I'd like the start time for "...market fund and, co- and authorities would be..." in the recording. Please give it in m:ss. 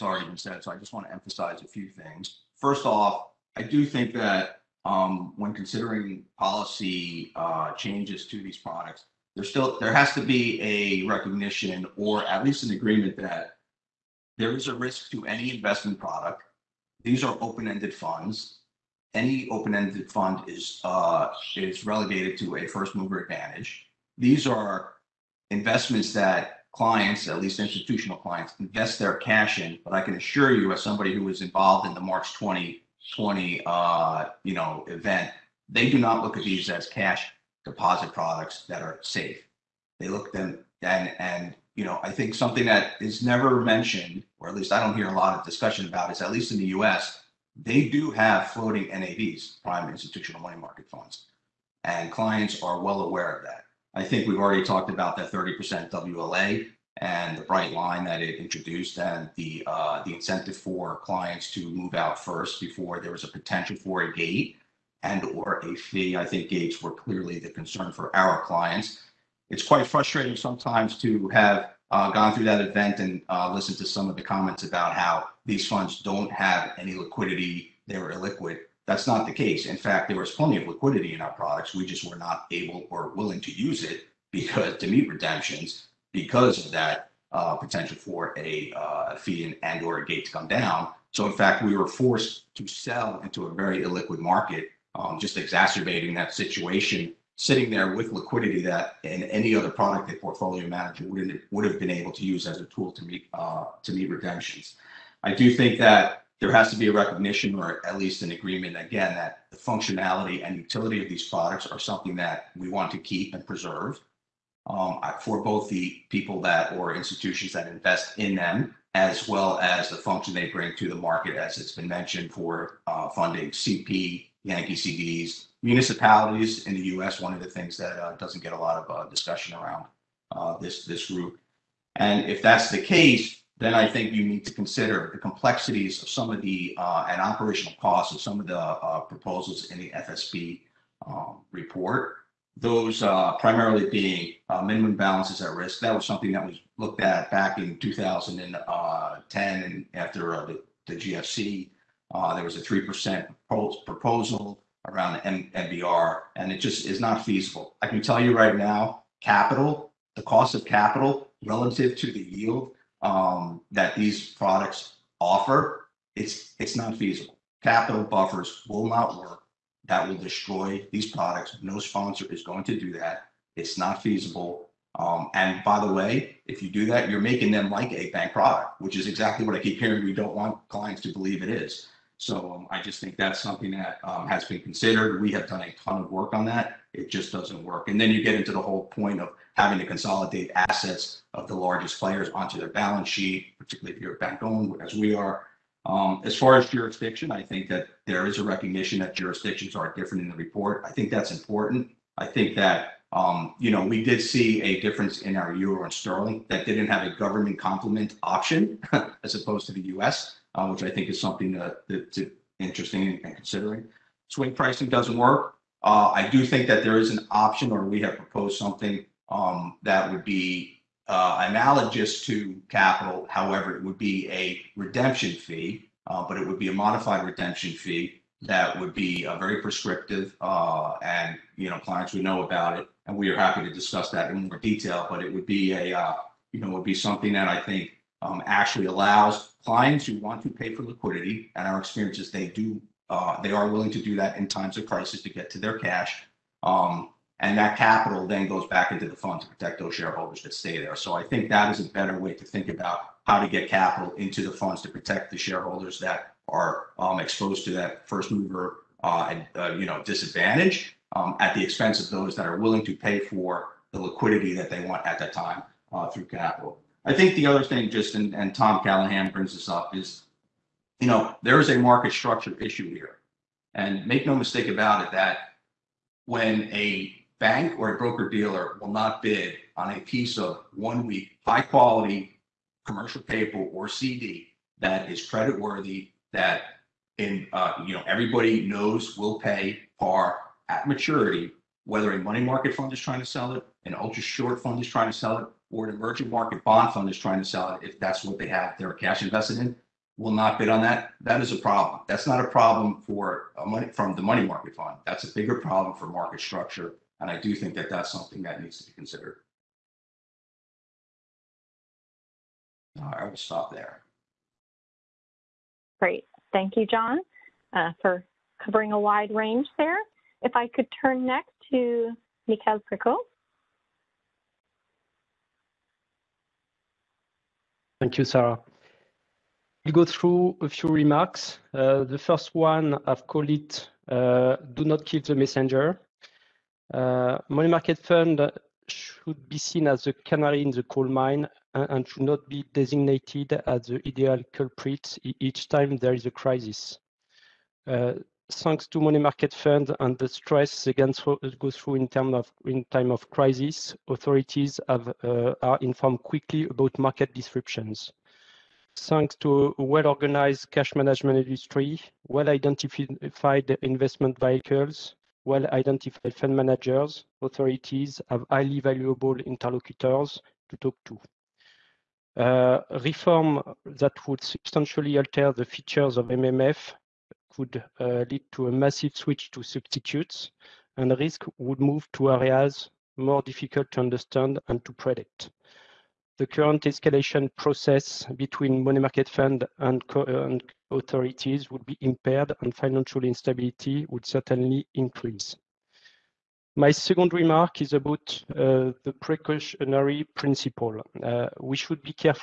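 6:28.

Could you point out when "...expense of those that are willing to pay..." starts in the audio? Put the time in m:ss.
4:21.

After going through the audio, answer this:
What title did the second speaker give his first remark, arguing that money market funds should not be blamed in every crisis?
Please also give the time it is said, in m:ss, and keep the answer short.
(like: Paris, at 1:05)
Do Not Kill the Messenger, at 5:34.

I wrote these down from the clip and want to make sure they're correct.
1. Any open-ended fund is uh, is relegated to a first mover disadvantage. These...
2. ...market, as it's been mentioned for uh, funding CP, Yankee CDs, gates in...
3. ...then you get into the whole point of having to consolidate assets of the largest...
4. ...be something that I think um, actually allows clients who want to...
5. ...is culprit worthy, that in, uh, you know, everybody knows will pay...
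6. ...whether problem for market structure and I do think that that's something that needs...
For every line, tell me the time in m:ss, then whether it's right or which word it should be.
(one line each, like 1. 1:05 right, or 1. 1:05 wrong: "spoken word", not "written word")
1. 0:19 wrong: "advantage", not "disadvantage"
2. 2:00 wrong: "municipalities", not "gates"
3. 3:07 right
4. 3:56 right
5. 4:45 wrong: "credit", not "culprit"
6. 5:05 wrong: "bigger", not "whether".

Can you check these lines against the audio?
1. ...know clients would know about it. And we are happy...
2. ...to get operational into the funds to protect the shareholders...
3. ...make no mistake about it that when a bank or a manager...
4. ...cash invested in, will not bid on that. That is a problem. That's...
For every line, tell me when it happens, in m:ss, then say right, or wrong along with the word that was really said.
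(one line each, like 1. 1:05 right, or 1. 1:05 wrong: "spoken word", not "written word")
1. 3:51 right
2. 4:13 wrong: "capital", not "operational"
3. 4:34 wrong: "broker", not "manager"
4. 4:58 right.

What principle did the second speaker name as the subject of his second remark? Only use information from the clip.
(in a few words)
Precautionary principle.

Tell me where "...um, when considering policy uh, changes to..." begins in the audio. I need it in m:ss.
0:04.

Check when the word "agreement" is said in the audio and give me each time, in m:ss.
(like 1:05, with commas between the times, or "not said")
0:12, 1:48.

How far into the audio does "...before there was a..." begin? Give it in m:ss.
1:02.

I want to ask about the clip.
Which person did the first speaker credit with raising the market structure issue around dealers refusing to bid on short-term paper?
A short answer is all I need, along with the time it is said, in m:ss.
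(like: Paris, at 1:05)
Tom Callahan, at 4:28.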